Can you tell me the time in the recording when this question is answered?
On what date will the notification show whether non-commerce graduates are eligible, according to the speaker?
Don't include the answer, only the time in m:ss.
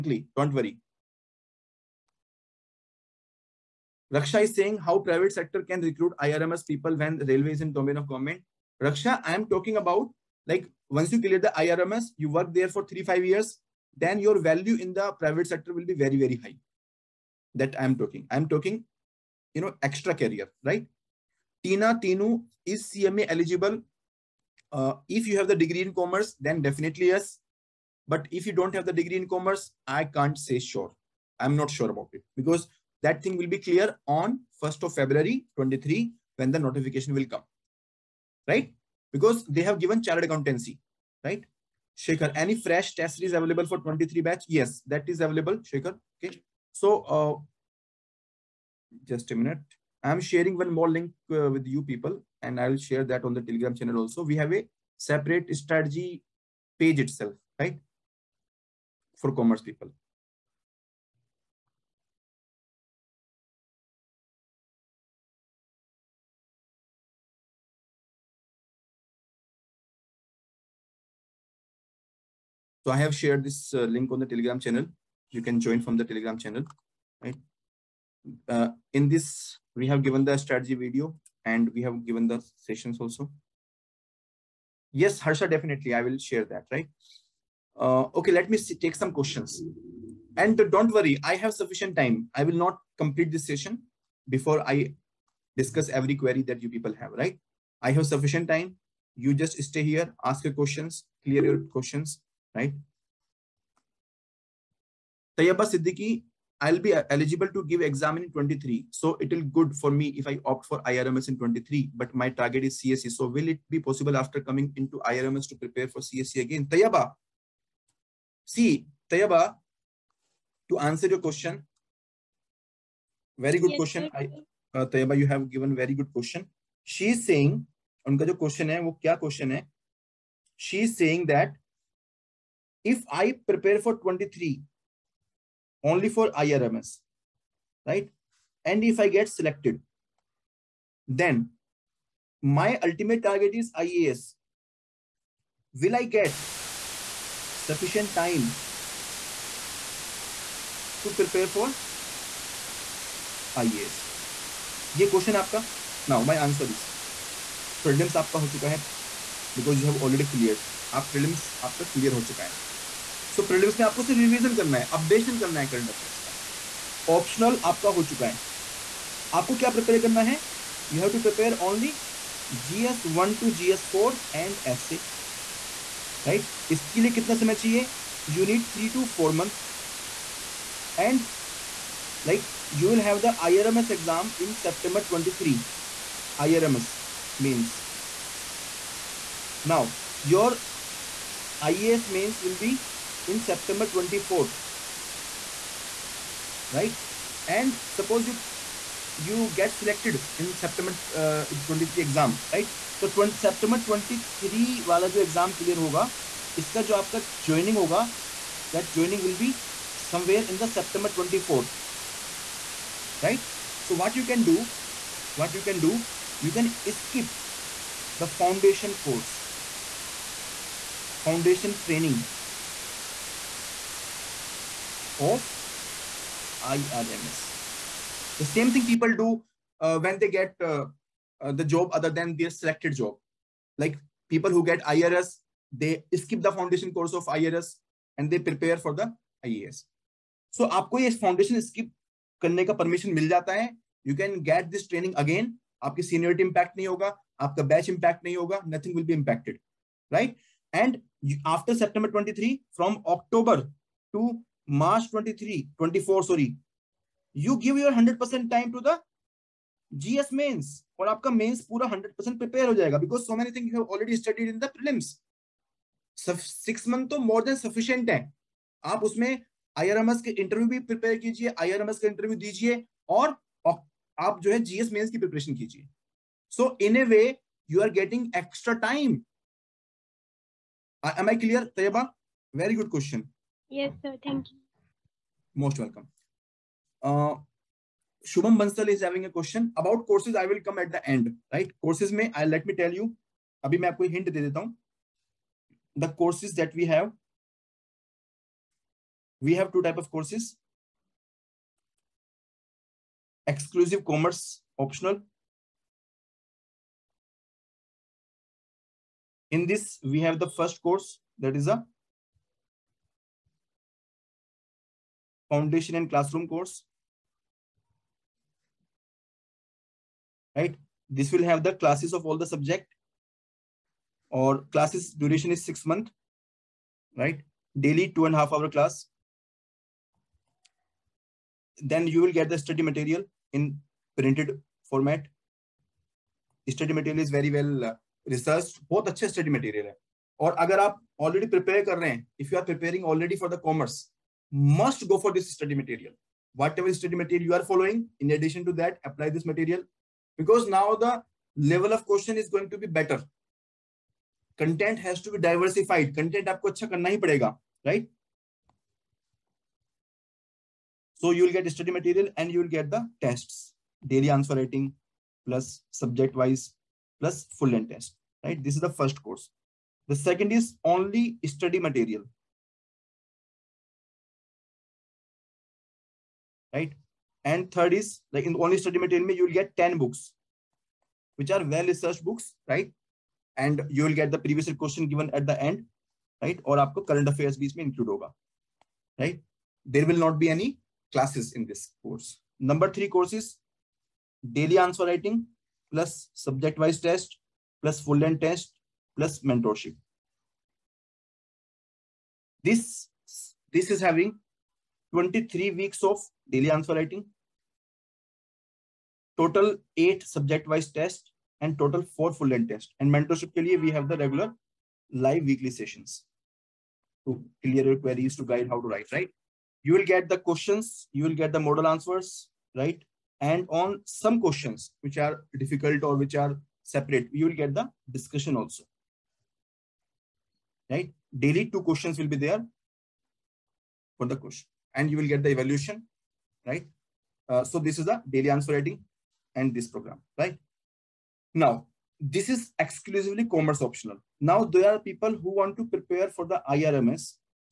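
0:34.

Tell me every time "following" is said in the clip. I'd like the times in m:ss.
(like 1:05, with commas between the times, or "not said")
5:47.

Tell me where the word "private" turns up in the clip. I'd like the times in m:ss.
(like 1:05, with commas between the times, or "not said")
0:04, 0:15.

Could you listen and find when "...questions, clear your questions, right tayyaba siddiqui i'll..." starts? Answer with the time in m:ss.
1:40.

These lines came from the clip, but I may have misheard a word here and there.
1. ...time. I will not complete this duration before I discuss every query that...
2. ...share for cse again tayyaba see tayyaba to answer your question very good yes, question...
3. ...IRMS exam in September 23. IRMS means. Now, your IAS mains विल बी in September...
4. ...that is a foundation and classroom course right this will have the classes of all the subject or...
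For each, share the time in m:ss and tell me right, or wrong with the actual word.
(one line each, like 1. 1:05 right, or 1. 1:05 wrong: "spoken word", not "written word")
1. 1:31 wrong: "session", not "duration"
2. 1:55 wrong: "prepare", not "share"
3. 3:03 right
4. 5:11 right.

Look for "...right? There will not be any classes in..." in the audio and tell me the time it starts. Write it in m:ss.
6:29.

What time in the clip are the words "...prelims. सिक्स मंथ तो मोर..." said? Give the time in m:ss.
4:24.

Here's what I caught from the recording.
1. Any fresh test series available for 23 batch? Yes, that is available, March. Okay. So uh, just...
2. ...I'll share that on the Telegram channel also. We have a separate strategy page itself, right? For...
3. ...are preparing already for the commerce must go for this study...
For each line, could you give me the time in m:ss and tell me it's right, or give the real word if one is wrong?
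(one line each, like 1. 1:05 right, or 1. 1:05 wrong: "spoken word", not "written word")
1. 0:42 wrong: "Shaker", not "March"
2. 0:52 right
3. 5:42 right.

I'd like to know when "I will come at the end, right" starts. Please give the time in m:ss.
4:50.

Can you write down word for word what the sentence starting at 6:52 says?
And mentorship ke liye we have the regular live weekly sessions to clear your queries to guide how to write, right?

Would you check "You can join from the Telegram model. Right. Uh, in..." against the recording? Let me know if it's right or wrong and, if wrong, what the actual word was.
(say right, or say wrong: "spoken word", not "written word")
wrong: "channel", not "model".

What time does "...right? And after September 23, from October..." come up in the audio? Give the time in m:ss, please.
4:10.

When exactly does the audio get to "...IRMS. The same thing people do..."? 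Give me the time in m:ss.
3:46.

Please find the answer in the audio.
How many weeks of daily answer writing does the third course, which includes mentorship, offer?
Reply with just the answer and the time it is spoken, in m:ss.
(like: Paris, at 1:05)
23, at 6:45.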